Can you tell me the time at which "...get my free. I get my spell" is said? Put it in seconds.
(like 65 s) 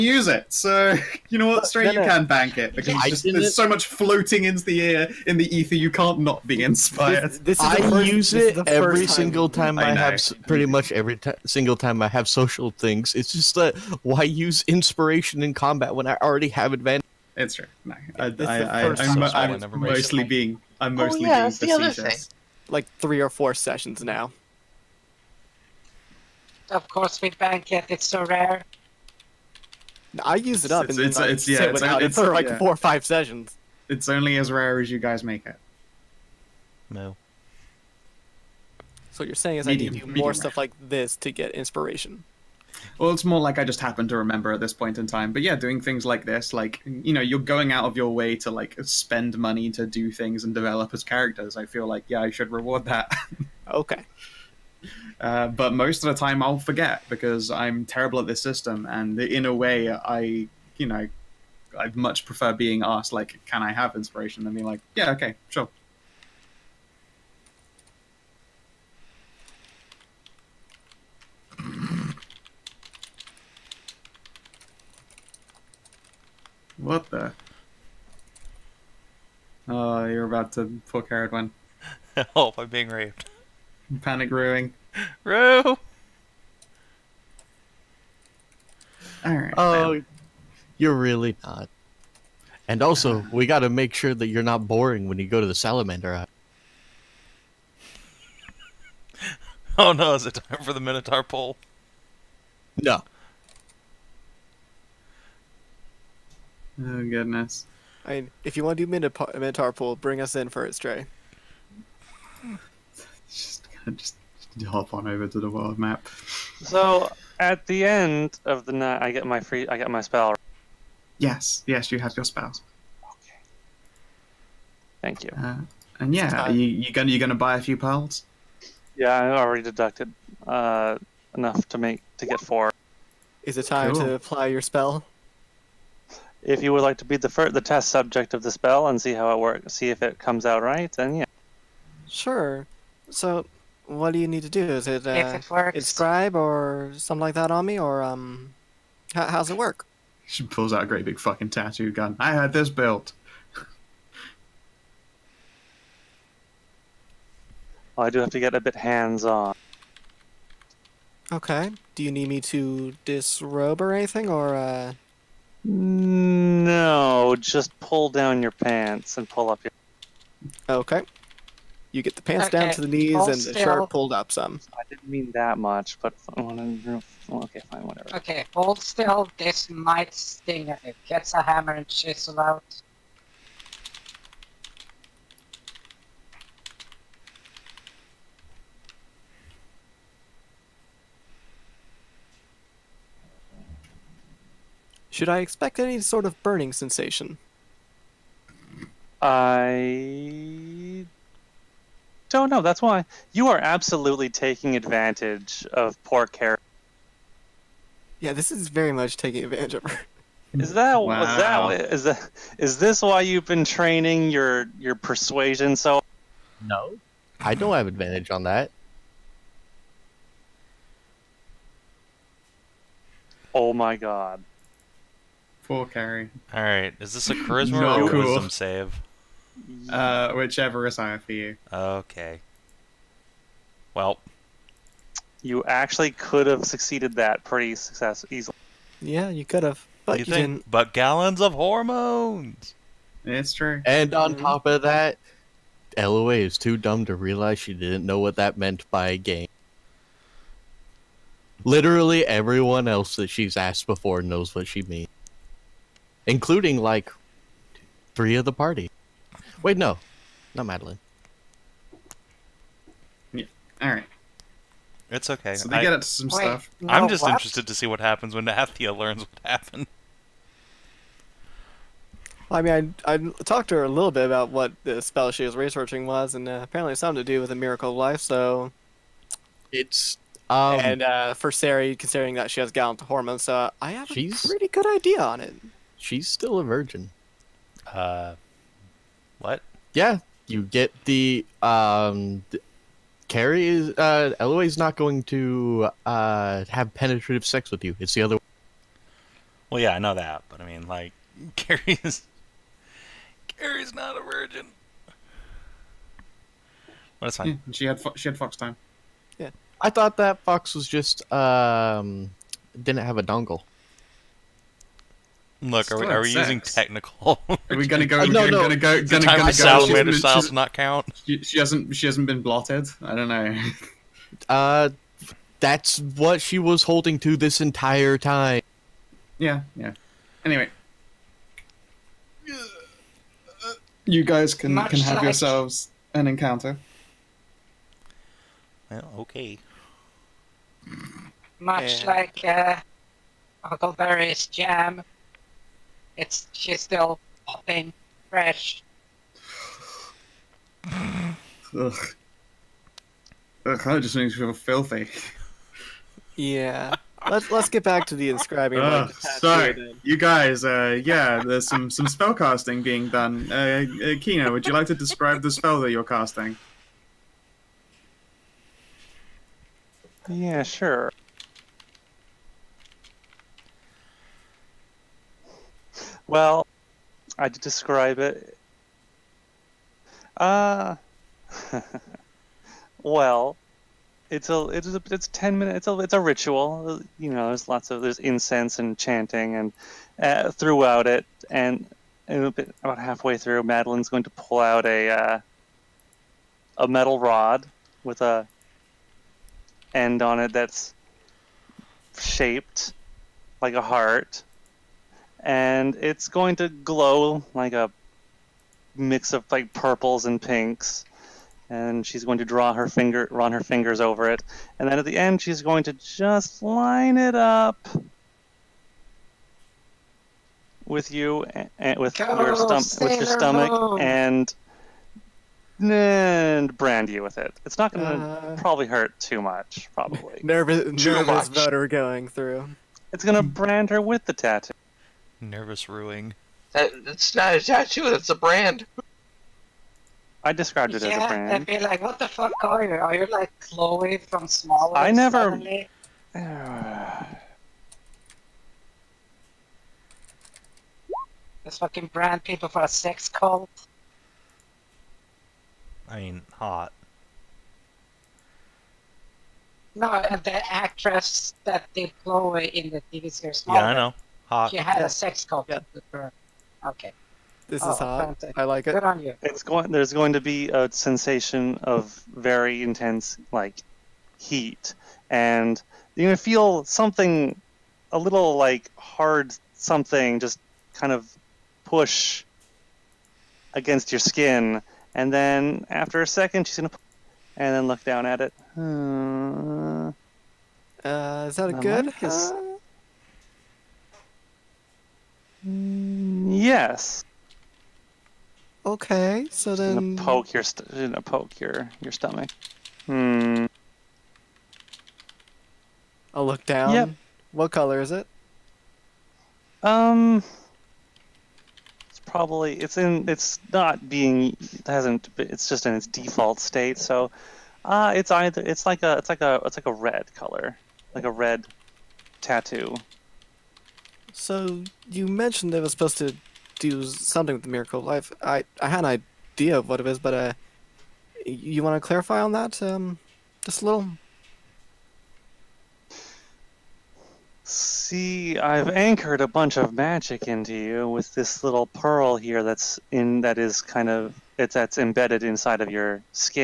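119 s.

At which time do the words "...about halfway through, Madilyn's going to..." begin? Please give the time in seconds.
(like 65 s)
392 s.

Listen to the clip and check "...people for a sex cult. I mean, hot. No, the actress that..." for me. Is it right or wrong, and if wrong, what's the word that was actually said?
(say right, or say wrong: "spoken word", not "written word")
right.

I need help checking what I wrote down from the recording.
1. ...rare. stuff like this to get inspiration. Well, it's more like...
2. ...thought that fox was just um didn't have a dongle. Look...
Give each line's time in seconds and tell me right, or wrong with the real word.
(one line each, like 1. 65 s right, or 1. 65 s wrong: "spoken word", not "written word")
1. 40 s right
2. 309 s right.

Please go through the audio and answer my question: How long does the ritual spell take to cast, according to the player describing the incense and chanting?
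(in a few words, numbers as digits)
10 minutes.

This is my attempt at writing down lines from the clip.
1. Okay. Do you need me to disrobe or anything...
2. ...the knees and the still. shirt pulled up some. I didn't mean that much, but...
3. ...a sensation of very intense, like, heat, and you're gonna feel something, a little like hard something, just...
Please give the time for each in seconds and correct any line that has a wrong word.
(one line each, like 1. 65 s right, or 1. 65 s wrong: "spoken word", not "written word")
1. 161 s right
2. 172 s right
3. 470 s right.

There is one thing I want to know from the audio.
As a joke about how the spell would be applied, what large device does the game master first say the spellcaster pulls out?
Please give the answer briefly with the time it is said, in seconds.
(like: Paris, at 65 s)
tattoo gun, at 151 s.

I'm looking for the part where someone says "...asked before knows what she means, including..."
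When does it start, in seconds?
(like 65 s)
253 s.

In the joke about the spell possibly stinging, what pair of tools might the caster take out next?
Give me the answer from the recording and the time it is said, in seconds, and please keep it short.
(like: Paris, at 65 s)
hammer and chisel, at 181 s.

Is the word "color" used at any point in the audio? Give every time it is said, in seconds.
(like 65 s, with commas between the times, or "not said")
507 s, 520 s.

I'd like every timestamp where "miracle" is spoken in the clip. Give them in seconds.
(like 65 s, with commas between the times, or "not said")
277 s, 527 s.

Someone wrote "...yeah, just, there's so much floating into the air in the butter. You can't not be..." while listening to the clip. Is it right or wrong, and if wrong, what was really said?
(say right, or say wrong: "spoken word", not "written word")
wrong: "ether", not "butter".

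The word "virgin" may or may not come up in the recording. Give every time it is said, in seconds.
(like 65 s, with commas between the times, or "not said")
286 s, 304 s.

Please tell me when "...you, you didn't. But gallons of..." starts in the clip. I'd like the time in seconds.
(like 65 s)
240 s.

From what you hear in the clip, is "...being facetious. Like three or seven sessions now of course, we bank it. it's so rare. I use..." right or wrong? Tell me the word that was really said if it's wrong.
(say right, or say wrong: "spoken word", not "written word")
wrong: "four", not "seven".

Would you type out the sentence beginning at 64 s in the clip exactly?
than being like, yeah, okay, sure.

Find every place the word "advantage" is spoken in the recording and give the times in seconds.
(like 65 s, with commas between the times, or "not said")
16 s, 204 s, 209 s, 217 s.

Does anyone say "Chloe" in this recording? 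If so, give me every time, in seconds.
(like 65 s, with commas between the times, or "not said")
443 s, 462 s.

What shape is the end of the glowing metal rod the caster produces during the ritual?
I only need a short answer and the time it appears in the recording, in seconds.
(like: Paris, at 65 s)
Heart, at 403 s.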